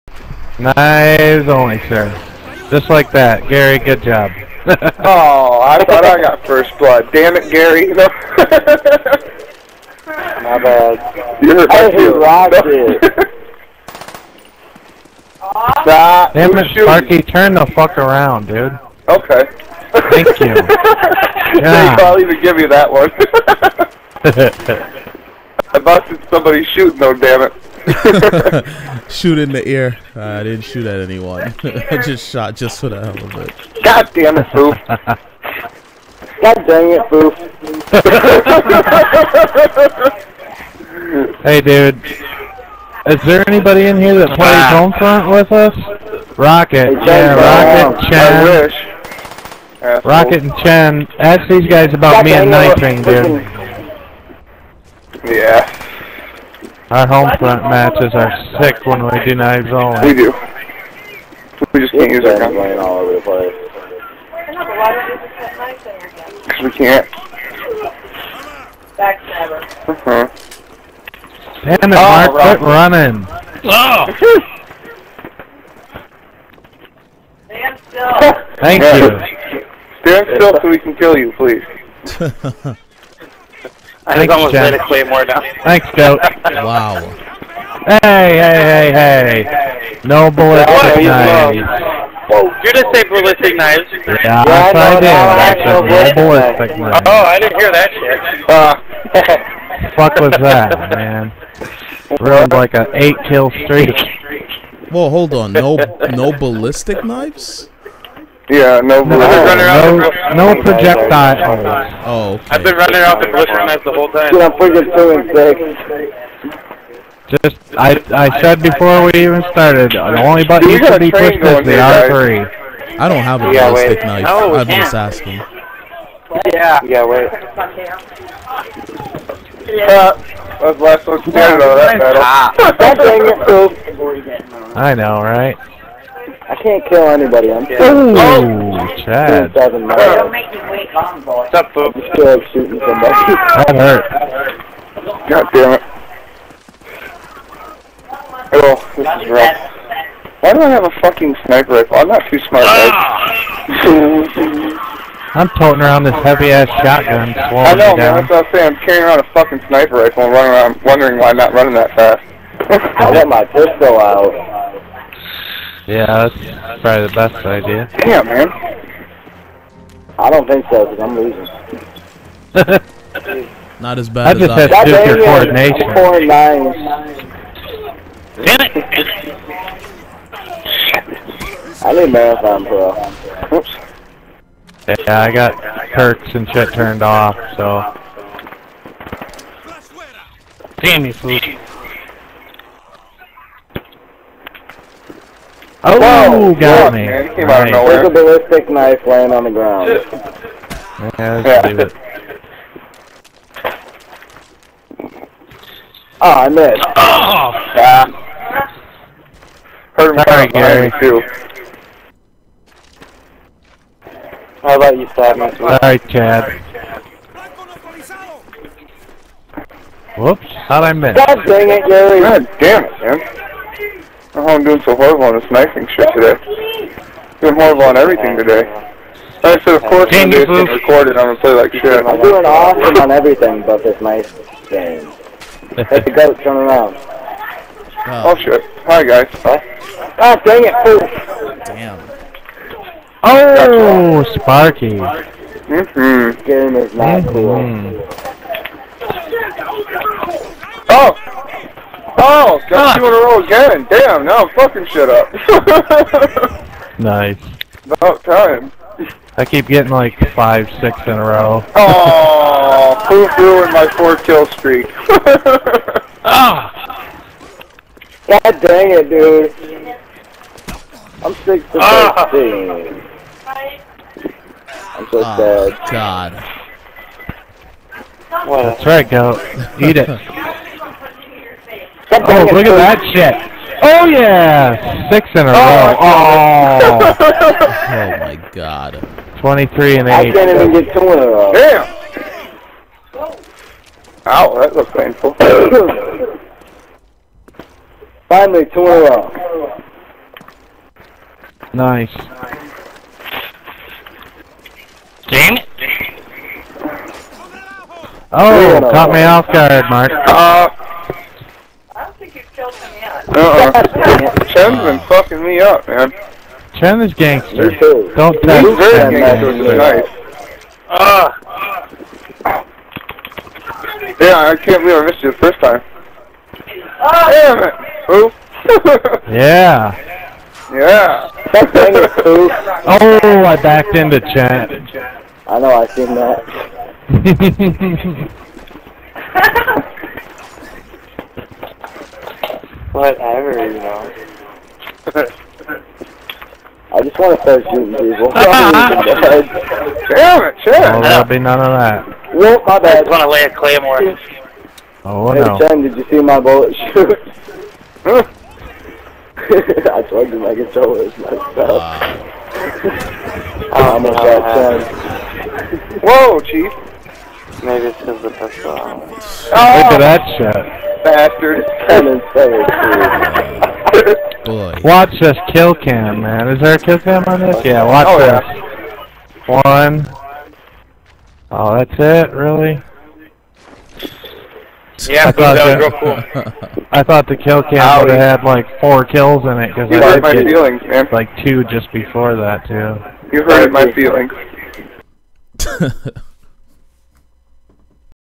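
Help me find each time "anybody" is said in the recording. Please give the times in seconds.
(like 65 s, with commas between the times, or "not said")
43 s, 137 s.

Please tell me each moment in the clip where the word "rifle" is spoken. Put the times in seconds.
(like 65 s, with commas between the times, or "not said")
151 s, 159 s.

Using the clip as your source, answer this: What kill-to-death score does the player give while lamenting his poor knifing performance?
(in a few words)
6 to 13.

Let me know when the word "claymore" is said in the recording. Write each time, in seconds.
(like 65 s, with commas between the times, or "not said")
84 s, 353 s.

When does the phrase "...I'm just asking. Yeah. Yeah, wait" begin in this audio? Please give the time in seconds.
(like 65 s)
124 s.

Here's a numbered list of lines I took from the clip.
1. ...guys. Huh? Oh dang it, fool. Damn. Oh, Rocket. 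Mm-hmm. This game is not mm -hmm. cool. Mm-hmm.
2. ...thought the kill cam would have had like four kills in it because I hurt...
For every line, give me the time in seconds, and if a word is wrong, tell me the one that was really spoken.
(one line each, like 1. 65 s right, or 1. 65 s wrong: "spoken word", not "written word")
1. 239 s wrong: "Sparky", not "Rocket"
2. 387 s right.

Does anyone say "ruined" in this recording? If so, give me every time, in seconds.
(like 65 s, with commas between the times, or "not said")
102 s, 263 s.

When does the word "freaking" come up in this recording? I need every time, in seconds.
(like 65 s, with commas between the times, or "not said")
114 s.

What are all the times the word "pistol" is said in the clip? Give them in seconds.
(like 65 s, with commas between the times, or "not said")
163 s, 368 s.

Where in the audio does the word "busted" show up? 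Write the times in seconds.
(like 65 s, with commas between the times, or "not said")
25 s.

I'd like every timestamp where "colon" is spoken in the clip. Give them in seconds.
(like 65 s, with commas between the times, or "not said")
not said.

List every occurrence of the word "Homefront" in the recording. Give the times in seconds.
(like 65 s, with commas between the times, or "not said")
44 s, 57 s.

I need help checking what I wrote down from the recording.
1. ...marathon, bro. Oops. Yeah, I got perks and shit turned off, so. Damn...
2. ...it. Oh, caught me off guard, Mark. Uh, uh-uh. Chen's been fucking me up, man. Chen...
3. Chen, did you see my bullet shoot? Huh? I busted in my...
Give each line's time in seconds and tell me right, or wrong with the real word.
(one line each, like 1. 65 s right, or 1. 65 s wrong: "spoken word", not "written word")
1. 182 s right
2. 305 s right
3. 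355 s wrong: "plugged", not "busted".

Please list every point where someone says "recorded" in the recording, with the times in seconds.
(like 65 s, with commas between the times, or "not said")
230 s.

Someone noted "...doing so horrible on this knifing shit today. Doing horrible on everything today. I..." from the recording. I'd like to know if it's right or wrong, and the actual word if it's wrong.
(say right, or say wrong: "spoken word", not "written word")
right.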